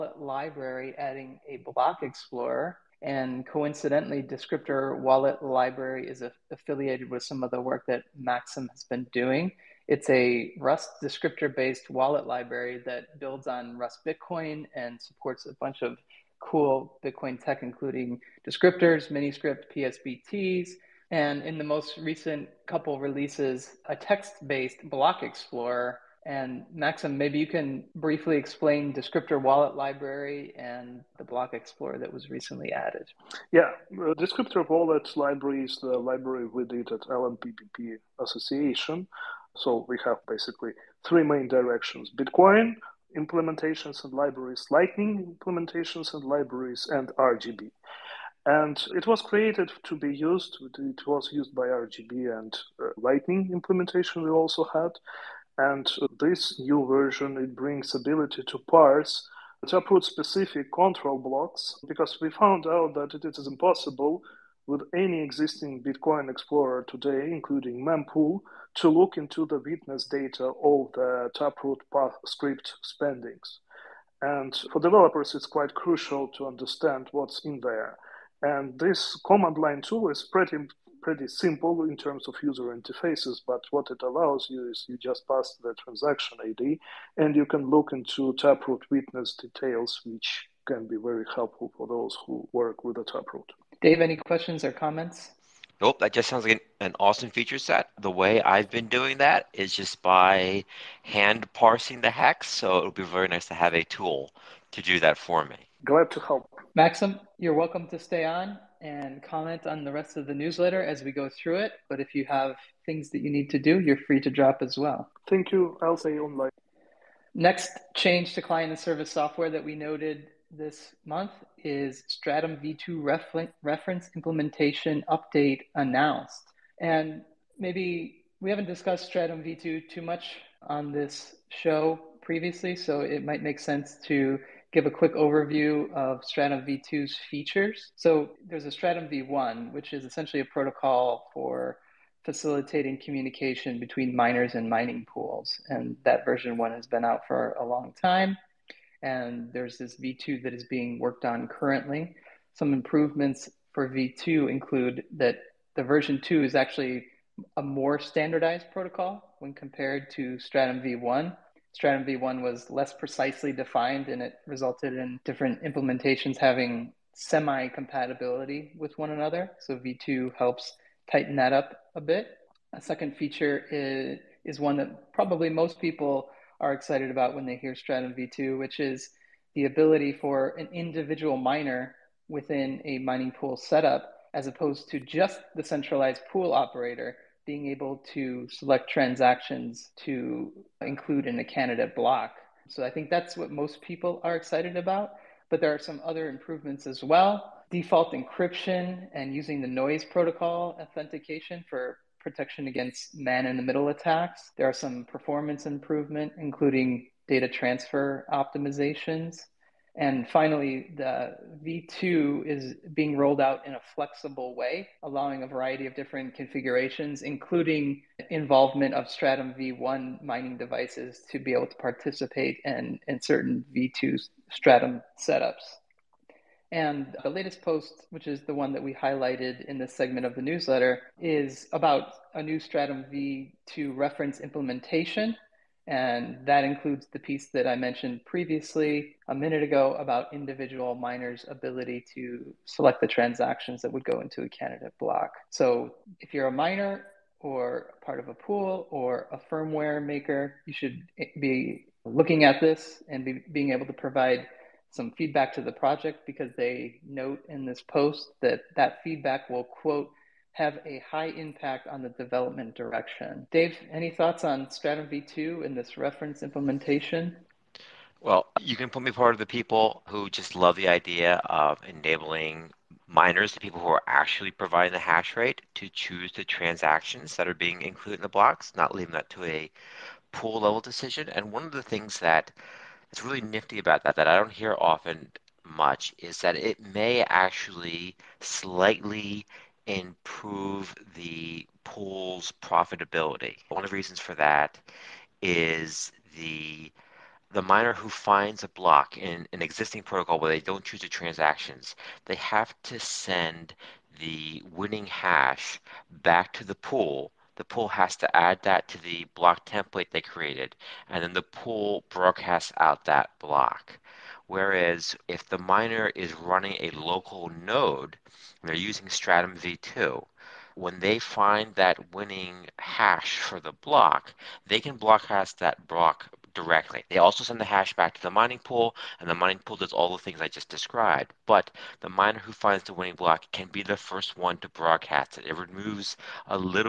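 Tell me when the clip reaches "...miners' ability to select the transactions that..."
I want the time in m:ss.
4:00.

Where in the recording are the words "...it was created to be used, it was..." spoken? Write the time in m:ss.
0:48.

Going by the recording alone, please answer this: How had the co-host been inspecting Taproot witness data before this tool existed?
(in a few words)
hand parsing the hex.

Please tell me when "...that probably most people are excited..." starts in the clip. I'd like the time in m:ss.
2:54.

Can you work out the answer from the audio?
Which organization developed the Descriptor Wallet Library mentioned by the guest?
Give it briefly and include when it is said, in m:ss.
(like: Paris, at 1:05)
LNPBP Association, at 0:37.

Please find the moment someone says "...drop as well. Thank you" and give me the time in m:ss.
1:54.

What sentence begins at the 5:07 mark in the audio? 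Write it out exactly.
The pool has to add that to the block template they created, and then the pool broadcasts out that block.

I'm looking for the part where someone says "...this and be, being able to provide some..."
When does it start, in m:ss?
4:12.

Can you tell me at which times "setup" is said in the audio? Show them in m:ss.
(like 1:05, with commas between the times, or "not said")
3:03, 3:45.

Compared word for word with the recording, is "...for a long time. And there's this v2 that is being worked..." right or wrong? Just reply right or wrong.
right.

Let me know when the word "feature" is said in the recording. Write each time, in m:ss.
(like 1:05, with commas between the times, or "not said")
1:37, 2:17, 2:53.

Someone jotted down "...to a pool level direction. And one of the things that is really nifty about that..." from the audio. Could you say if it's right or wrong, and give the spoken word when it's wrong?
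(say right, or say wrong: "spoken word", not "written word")
wrong: "decision", not "direction".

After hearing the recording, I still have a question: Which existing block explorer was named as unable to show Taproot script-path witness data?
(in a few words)
Mempool.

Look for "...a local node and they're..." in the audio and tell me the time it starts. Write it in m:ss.
5:16.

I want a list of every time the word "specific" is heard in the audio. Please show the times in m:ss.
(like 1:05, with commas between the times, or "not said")
1:00.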